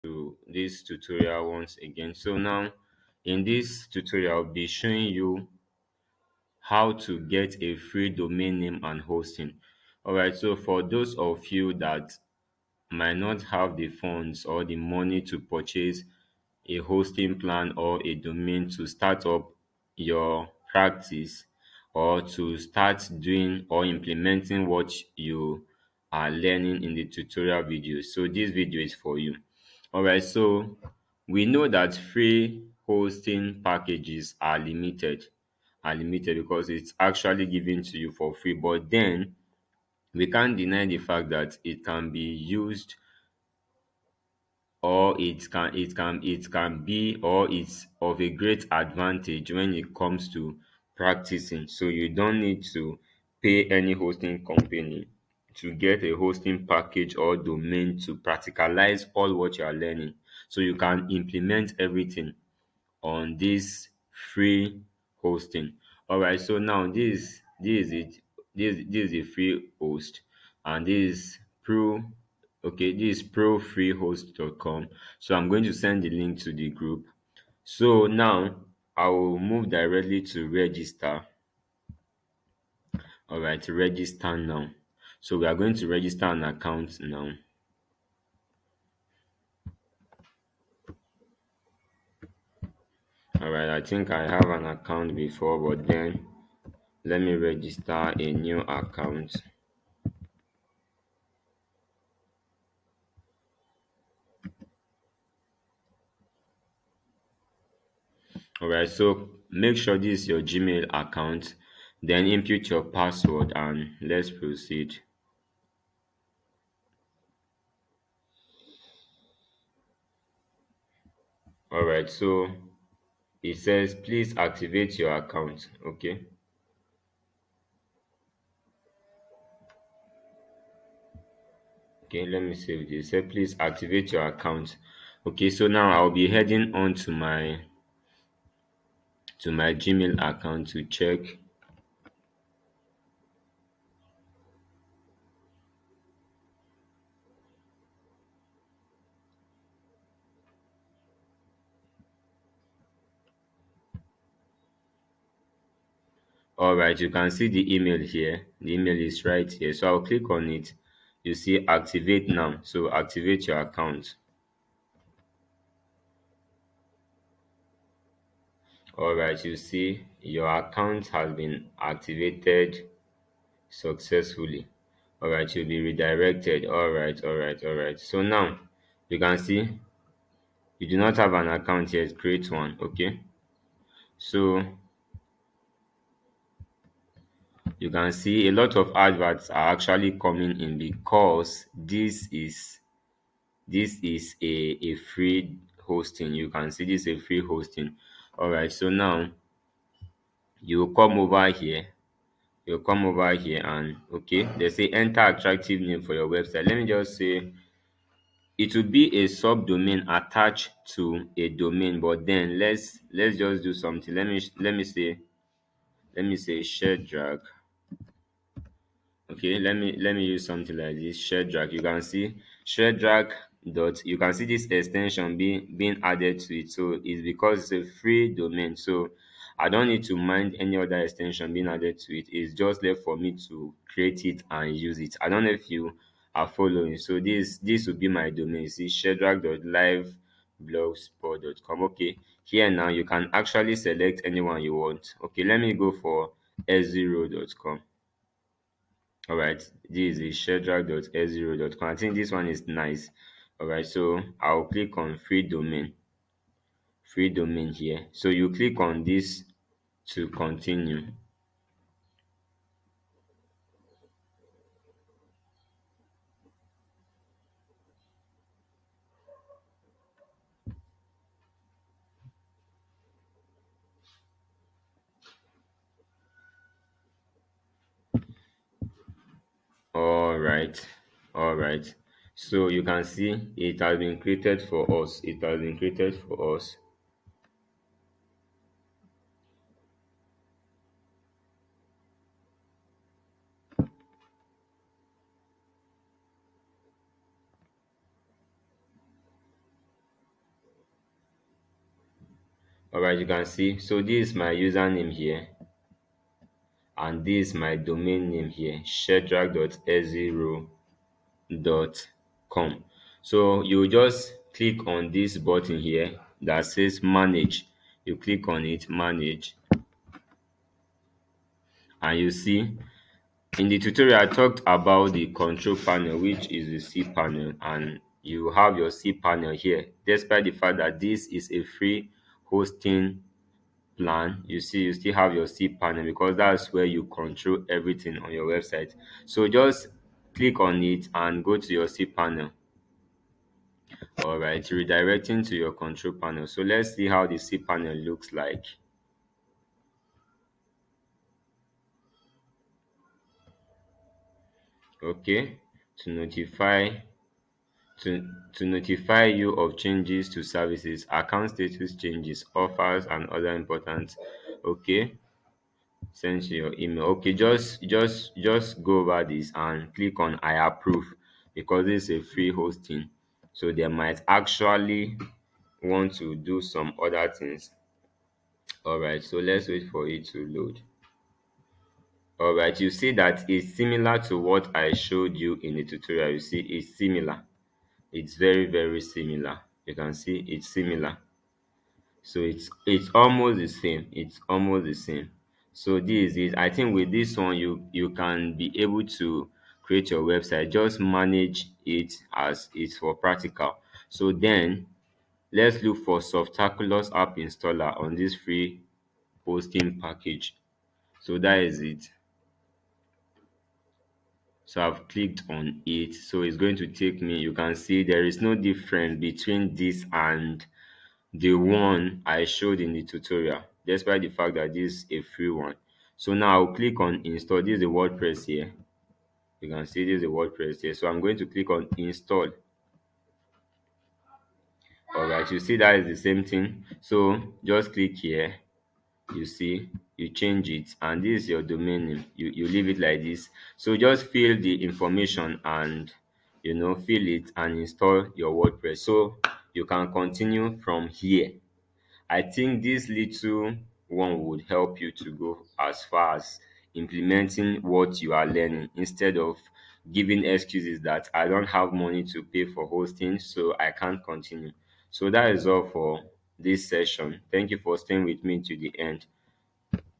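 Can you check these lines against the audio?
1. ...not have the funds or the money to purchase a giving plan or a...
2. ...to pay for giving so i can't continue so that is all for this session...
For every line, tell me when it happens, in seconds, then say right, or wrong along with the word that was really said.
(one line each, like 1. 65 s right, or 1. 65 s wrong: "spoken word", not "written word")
1. 13 s wrong: "hosting", not "giving"
2. 462 s wrong: "hosting", not "giving".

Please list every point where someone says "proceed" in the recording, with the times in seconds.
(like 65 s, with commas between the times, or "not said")
114 s.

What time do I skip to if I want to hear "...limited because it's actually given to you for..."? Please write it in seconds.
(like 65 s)
35 s.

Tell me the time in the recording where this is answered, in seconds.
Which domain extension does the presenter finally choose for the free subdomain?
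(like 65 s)
246 s.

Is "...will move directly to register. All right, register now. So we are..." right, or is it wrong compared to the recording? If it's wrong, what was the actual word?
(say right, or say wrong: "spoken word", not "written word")
right.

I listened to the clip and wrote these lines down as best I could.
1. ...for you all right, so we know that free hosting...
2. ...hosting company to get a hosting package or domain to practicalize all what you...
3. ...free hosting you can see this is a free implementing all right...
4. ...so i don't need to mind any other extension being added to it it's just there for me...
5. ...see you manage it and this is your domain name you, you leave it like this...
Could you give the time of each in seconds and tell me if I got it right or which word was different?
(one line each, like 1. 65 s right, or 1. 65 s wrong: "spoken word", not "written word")
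1. 28 s right
2. 53 s right
3. 194 s wrong: "hosting", not "implementing"
4. 228 s right
5. 439 s wrong: "change", not "manage".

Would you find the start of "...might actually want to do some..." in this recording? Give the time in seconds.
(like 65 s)
373 s.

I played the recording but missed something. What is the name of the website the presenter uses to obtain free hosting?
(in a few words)
profreehost.com.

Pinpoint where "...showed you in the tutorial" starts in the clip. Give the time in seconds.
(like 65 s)
384 s.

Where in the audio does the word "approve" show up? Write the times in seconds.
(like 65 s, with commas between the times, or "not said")
370 s.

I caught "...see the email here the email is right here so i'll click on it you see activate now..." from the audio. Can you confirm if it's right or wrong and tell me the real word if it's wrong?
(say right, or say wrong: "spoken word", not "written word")
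right.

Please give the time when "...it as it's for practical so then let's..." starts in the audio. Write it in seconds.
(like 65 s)
401 s.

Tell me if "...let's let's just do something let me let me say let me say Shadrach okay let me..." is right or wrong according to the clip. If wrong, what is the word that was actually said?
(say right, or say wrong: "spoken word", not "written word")
right.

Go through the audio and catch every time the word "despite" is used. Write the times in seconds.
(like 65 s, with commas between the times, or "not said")
330 s, 423 s.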